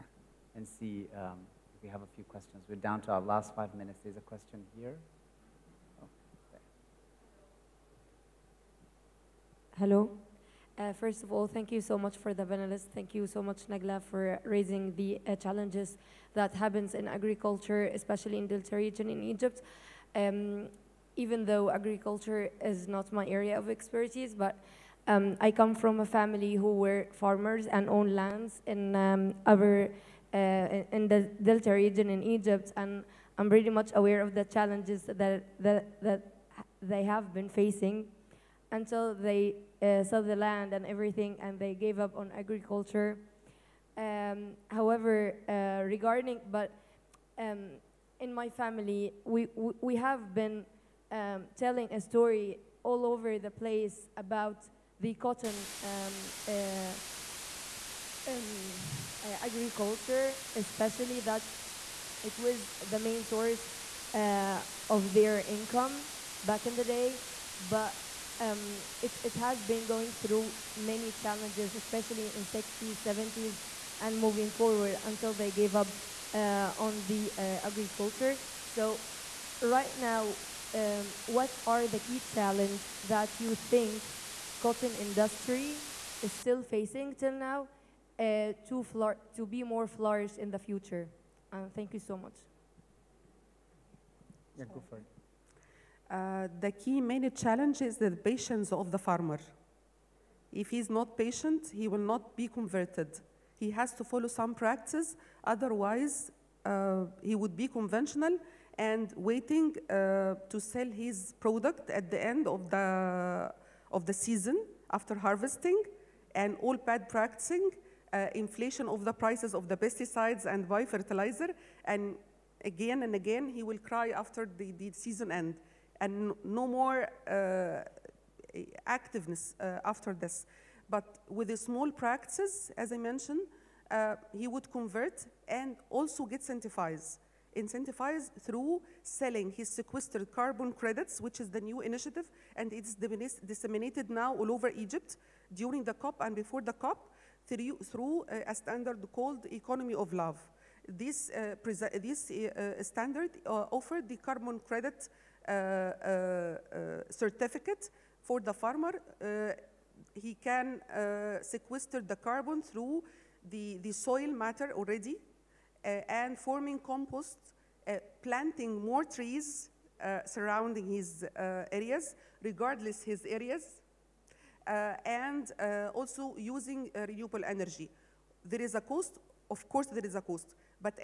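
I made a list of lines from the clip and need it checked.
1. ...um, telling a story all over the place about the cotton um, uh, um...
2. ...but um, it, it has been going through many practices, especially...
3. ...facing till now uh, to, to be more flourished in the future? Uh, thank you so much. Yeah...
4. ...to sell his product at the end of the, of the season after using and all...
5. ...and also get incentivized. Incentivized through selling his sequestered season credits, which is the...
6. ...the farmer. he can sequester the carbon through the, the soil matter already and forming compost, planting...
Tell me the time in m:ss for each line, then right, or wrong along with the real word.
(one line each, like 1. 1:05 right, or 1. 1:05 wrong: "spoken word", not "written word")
1. 0:51 right
2. 1:07 wrong: "challenges", not "practices"
3. 1:26 right
4. 1:50 wrong: "harvesting", not "using"
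5. 2:15 wrong: "carbon", not "season"
6. 2:38 right.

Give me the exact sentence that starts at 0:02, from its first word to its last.
We're down to our last five minutes.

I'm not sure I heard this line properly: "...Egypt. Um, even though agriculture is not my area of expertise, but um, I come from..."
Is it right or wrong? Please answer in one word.
right.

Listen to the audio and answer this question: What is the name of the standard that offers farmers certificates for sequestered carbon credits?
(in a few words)
Economy of Love.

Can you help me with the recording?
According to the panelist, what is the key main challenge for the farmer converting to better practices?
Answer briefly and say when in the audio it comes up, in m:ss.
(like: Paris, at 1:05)
Patience of the farmer, at 1:37.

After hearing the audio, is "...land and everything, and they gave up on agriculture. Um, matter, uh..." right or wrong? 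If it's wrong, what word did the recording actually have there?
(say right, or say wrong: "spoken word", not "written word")
wrong: "however", not "matter".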